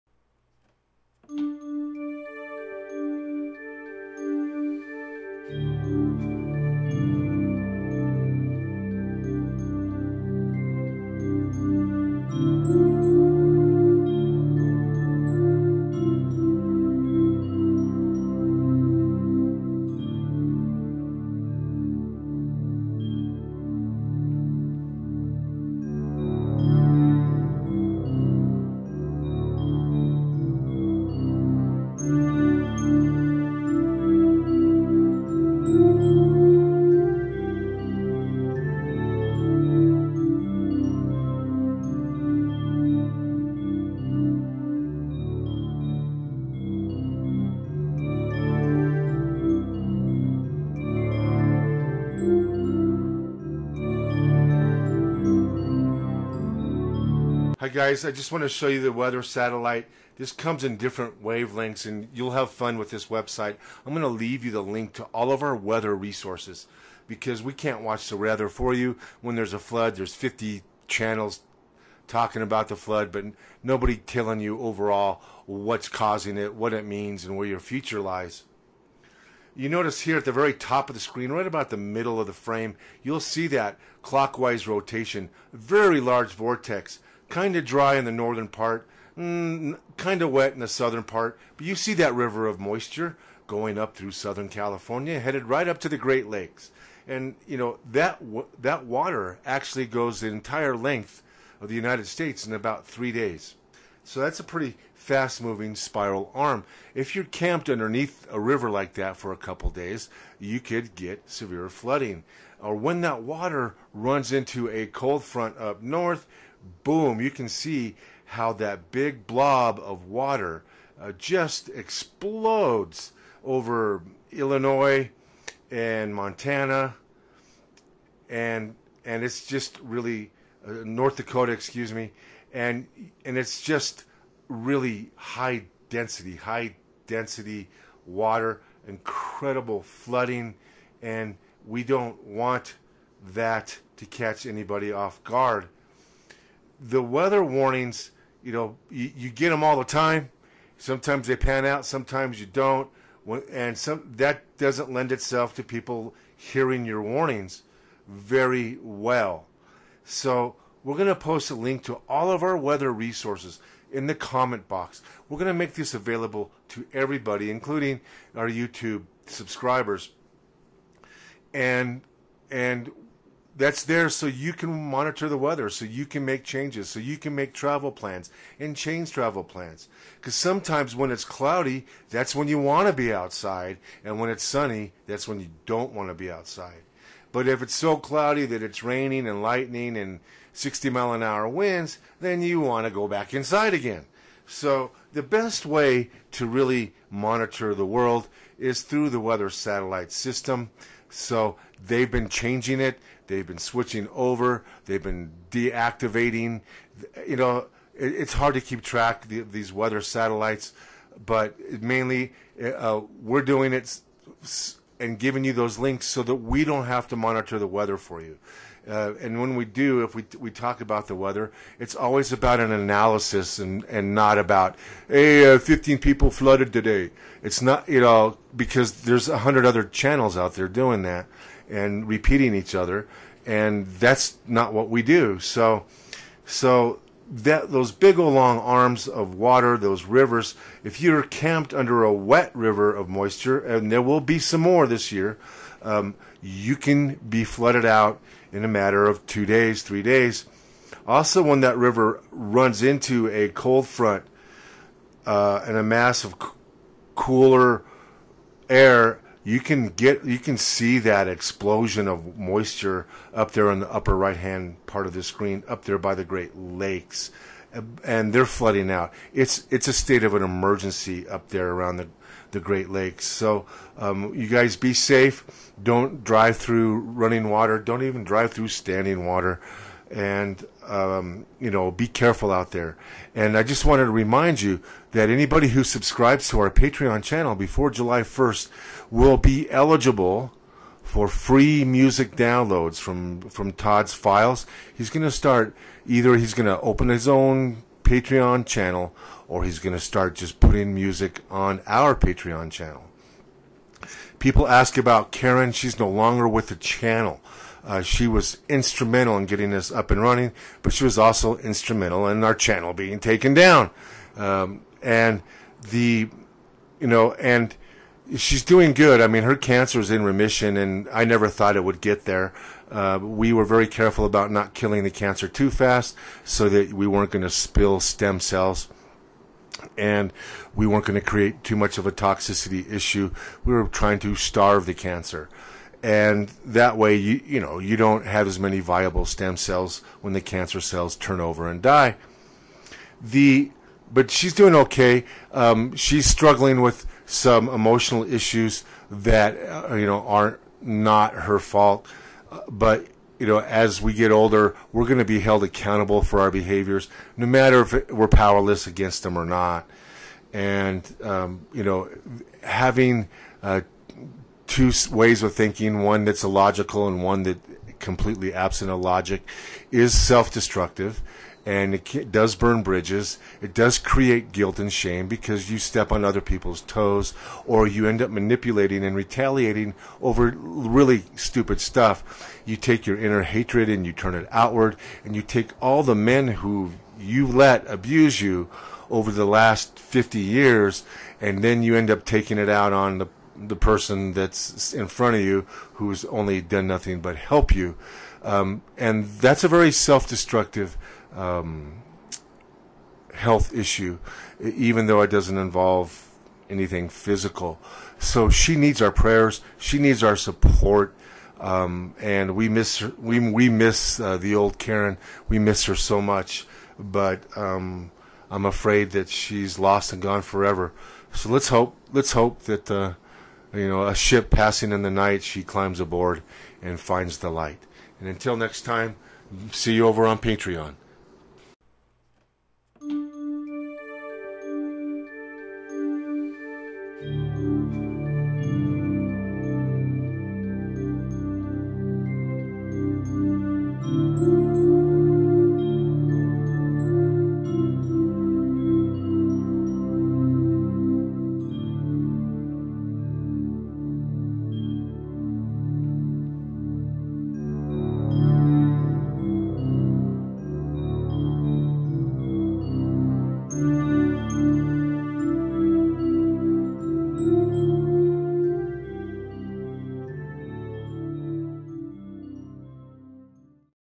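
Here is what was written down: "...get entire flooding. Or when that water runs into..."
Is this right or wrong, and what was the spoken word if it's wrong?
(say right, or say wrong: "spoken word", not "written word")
wrong: "severe", not "entire".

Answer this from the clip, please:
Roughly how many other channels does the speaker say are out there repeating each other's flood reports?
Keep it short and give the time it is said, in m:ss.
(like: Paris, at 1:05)
100, at 3:49.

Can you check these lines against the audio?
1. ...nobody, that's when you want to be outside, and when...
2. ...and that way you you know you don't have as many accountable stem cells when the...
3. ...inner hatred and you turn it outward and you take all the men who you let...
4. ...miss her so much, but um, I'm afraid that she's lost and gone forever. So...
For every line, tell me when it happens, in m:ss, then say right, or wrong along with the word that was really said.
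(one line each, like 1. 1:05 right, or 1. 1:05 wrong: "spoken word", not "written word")
1. 3:01 wrong: "cloudy", not "nobody"
2. 5:36 wrong: "viable", not "accountable"
3. 6:23 right
4. 6:55 right.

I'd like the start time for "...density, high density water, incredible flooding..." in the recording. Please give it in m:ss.
2:15.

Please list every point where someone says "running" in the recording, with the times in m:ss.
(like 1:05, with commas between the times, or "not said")
4:36, 5:10.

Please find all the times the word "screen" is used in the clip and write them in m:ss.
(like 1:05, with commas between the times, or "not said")
1:21, 4:25.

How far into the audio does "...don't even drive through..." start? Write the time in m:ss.
4:37.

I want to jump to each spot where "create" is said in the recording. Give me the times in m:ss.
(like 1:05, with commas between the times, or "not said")
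5:31, 6:13.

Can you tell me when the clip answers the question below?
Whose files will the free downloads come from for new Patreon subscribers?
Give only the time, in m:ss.
4:53.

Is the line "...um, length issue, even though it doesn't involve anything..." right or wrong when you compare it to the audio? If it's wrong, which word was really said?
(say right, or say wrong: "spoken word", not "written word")
wrong: "health", not "length".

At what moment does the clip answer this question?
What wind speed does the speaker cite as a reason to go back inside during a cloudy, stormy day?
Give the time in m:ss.
3:10.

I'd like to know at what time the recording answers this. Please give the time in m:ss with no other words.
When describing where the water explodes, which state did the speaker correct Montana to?
2:10.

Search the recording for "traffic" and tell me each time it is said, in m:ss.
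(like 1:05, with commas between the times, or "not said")
not said.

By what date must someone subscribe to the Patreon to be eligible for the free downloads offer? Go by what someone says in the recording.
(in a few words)
July 1st.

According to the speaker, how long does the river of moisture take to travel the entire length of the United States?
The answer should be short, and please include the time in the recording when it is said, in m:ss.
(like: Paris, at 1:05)
3 days, at 1:42.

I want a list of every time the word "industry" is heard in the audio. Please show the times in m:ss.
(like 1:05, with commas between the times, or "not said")
not said.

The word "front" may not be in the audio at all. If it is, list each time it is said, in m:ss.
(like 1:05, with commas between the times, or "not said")
1:55, 4:13, 6:35.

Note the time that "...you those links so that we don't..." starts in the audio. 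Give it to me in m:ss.
3:35.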